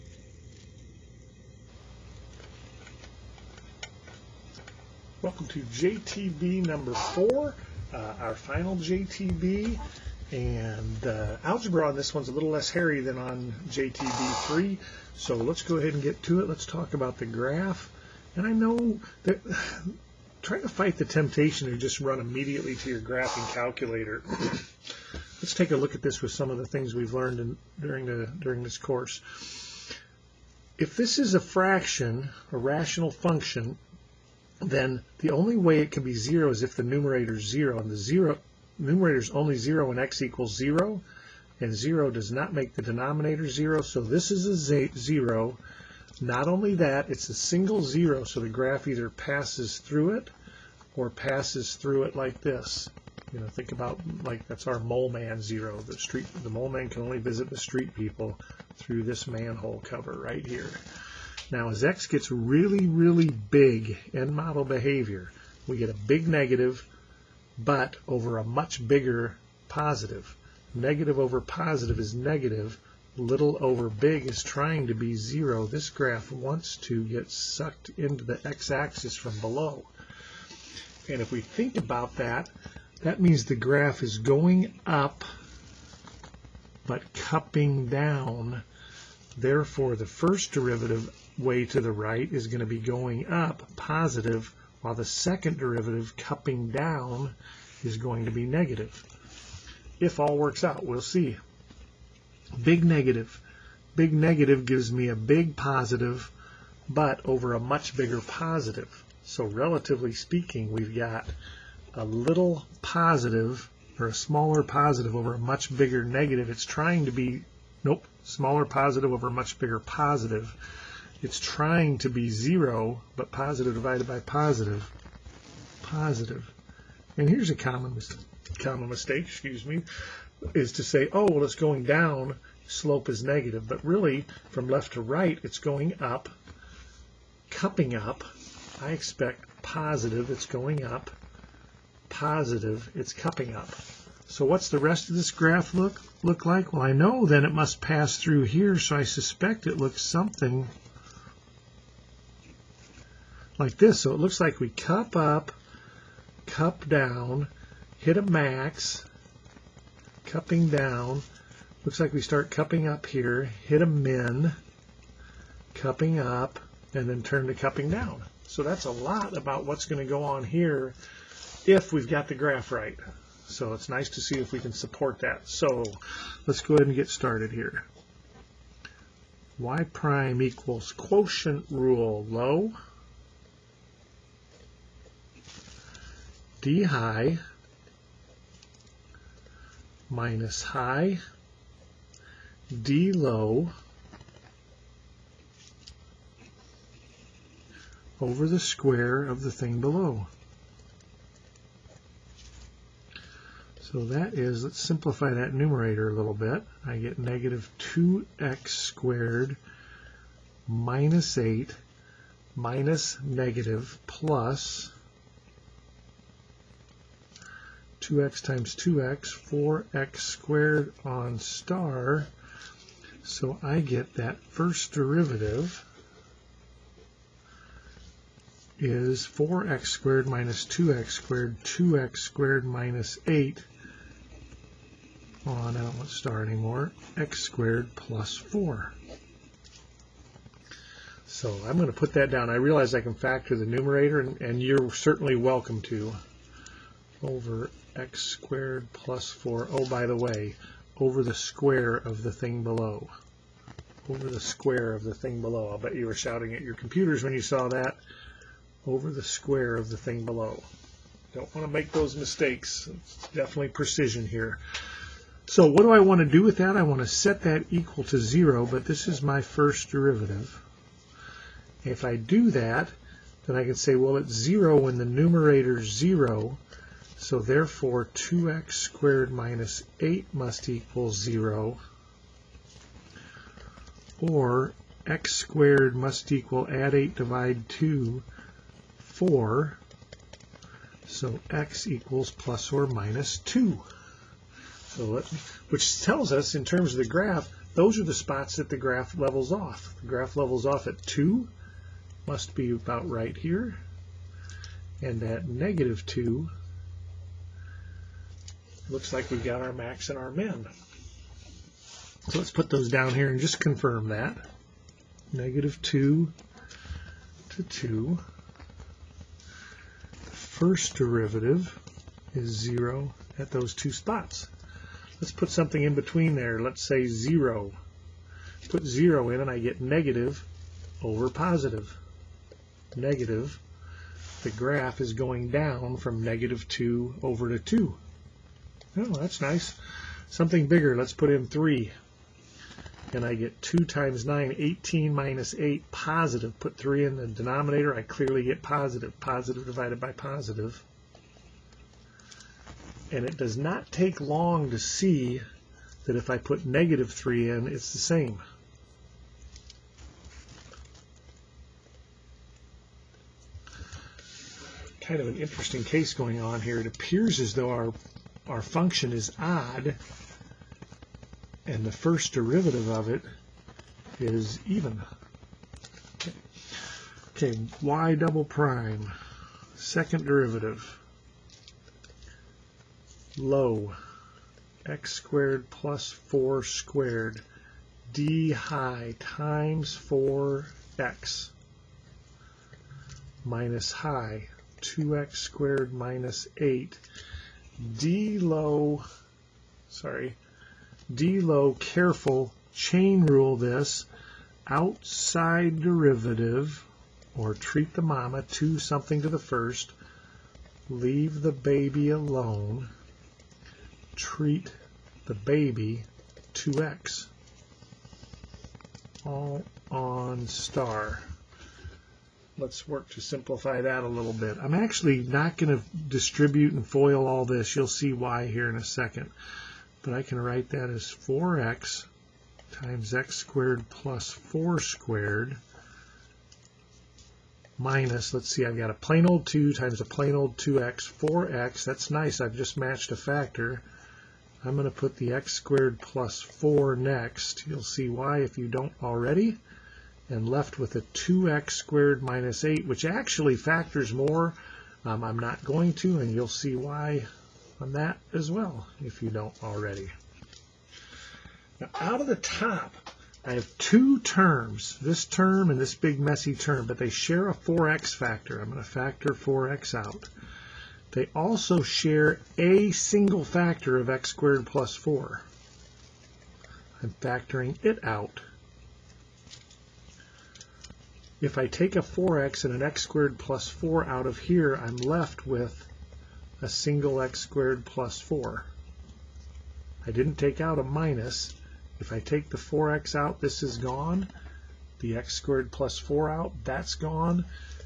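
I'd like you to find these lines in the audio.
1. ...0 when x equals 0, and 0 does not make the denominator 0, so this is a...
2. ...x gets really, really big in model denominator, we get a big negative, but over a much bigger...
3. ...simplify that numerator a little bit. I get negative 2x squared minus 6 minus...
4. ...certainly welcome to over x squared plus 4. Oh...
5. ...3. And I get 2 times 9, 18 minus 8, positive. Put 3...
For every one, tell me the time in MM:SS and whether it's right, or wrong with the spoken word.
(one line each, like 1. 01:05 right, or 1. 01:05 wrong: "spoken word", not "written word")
1. 00:39 right
2. 01:01 wrong: "behavior", not "denominator"
3. 03:24 wrong: "8", not "6"
4. 04:04 right
5. 05:41 right.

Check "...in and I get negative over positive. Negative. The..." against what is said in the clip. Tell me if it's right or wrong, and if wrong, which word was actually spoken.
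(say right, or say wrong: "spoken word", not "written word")
right.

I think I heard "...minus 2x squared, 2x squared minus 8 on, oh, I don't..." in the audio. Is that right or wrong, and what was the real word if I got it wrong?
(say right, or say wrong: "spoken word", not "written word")
right.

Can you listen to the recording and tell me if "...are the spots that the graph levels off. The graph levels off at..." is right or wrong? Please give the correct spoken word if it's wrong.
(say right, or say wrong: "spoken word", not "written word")
right.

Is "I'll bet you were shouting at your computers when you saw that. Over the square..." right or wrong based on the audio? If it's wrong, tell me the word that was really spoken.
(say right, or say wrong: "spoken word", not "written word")
right.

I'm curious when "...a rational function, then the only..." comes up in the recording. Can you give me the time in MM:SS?
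00:32.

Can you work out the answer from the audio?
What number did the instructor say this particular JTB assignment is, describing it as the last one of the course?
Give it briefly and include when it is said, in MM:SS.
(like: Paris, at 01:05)
4, at 00:06.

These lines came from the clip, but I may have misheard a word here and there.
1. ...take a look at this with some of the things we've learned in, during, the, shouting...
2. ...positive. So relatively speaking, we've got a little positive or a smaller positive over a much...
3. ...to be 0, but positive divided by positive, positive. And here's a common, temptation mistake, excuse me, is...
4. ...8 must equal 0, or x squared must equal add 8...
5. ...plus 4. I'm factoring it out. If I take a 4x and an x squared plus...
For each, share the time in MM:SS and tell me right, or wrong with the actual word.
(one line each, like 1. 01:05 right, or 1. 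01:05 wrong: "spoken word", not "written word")
1. 00:25 wrong: "during", not "shouting"
2. 01:48 right
3. 02:01 wrong: "common", not "temptation"
4. 04:40 right
5. 07:54 right.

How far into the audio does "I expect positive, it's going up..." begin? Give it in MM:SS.
02:18.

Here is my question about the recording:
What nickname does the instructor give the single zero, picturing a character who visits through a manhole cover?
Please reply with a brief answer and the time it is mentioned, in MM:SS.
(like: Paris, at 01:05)
mole man zero, at 00:54.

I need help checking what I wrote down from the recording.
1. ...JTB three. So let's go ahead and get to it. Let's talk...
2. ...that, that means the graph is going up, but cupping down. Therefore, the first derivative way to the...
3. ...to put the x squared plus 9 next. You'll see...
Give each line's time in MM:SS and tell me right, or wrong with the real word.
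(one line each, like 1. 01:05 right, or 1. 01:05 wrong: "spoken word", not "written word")
1. 00:13 right
2. 01:22 right
3. 07:24 wrong: "4", not "9".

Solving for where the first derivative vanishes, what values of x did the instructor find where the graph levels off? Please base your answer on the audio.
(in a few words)
plus or minus 2.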